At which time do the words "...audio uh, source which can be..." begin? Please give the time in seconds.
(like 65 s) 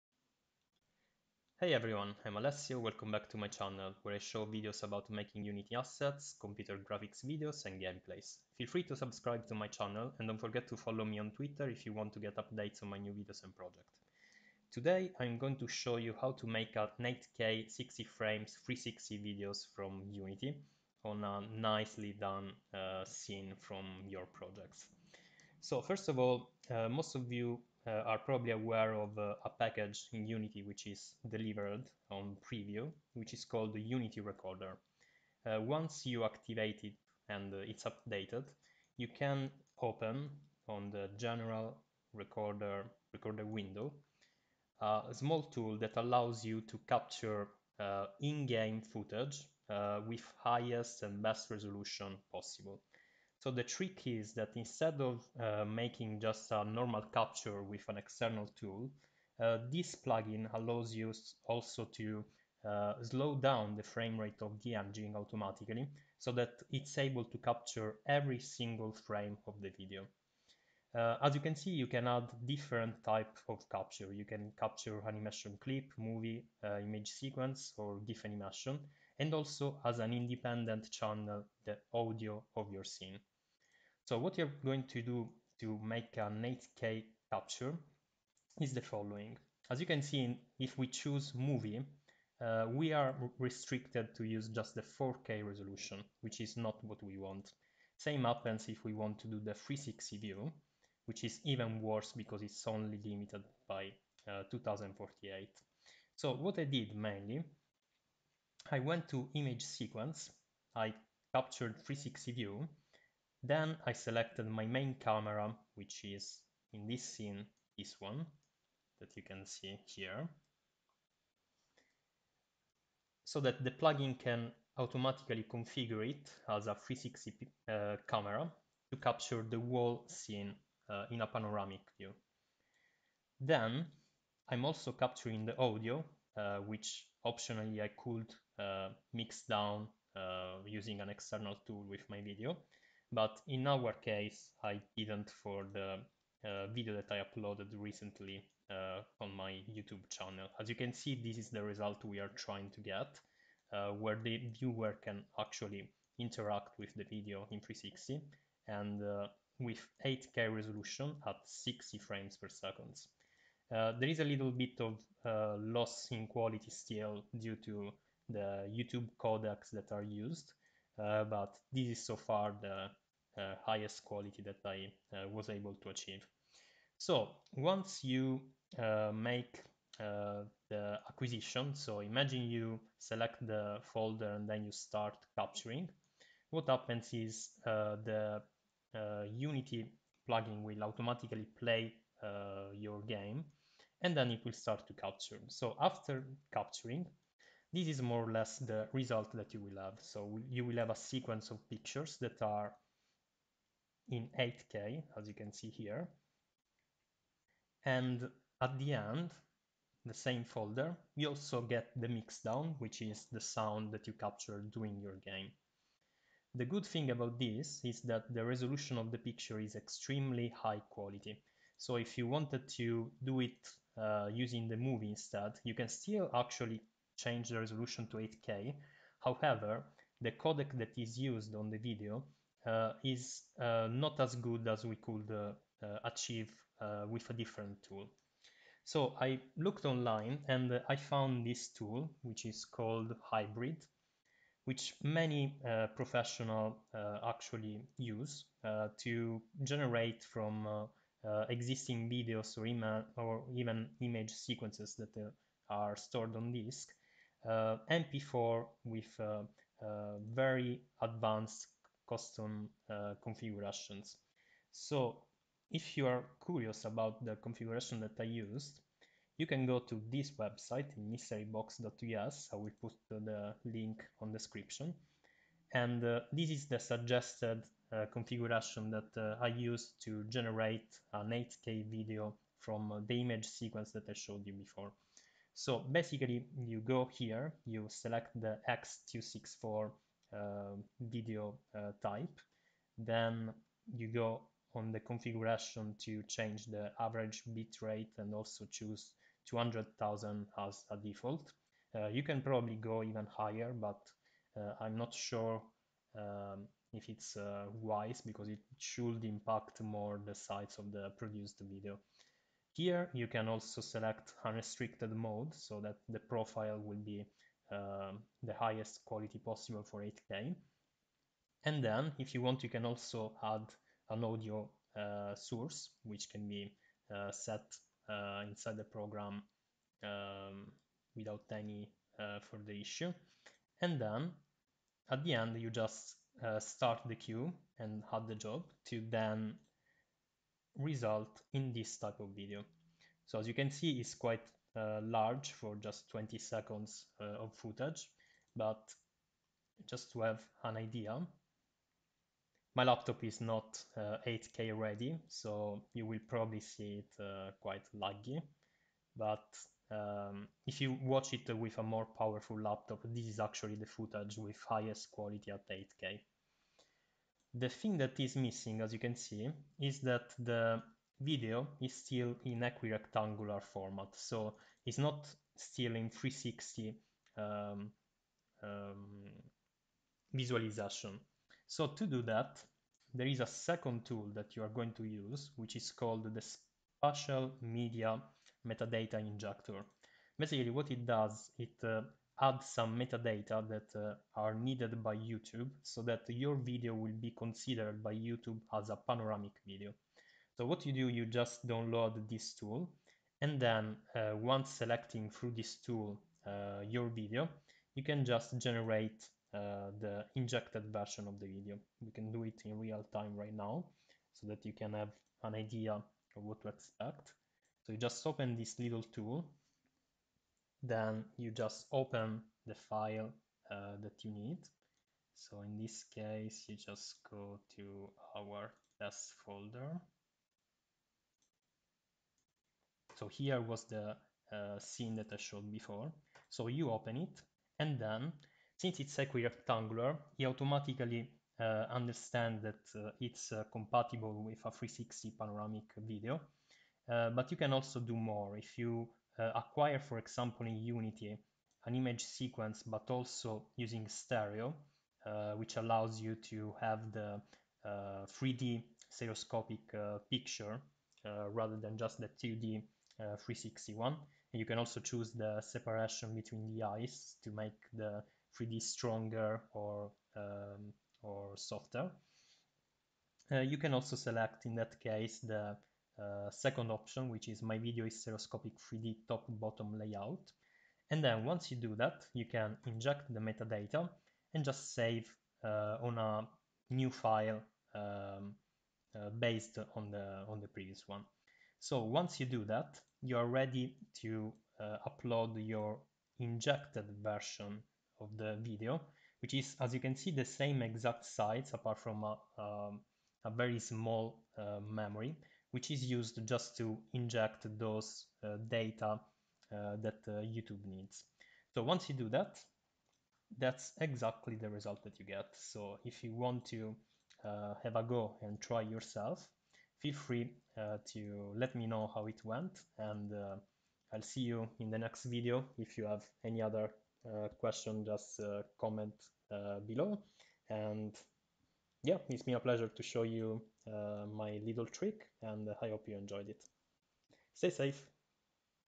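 324 s.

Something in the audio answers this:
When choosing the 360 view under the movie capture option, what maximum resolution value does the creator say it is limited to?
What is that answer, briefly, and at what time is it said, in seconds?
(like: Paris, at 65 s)
2048, at 104 s.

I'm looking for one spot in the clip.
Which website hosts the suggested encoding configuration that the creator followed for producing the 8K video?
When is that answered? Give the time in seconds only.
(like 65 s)
270 s.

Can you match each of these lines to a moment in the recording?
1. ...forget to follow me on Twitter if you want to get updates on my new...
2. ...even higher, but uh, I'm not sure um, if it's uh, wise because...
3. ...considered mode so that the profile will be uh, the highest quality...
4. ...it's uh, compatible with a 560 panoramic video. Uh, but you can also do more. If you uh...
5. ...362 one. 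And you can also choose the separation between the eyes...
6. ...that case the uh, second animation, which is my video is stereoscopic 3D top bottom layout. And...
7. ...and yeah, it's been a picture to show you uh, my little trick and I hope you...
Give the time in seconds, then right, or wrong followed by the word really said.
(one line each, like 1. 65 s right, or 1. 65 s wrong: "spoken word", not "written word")
1. 10 s right
2. 303 s right
3. 314 s wrong: "unrestricted", not "considered"
4. 443 s wrong: "360", not "560"
5. 463 s wrong: "360", not "362"
6. 474 s wrong: "option", not "animation"
7. 530 s wrong: "pleasure", not "picture".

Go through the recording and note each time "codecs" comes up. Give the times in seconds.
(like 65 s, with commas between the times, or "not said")
169 s, 230 s.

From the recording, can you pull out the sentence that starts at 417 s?
So you just open this little tool then you just open the file uh, that you need.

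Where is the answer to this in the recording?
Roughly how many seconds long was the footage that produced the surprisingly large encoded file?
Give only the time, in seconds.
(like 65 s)
346 s.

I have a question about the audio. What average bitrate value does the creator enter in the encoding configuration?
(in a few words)
200,000.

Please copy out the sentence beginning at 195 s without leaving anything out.
So after capturing, this is more or less the result that you will have.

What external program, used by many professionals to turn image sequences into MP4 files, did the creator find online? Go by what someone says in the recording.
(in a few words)
Hybrid.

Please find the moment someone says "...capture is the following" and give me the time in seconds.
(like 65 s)
87 s.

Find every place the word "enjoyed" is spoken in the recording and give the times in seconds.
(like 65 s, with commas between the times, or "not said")
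536 s.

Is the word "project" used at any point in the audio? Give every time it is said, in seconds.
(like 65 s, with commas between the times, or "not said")
13 s, 24 s.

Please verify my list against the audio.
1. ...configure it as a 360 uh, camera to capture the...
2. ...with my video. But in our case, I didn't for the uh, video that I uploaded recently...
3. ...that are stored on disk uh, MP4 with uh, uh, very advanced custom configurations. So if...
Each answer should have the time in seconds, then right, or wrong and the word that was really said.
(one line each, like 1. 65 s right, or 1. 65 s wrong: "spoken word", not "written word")
1. 125 s right
2. 141 s right
3. 254 s right.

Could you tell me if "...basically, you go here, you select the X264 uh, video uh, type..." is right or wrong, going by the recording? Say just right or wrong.
right.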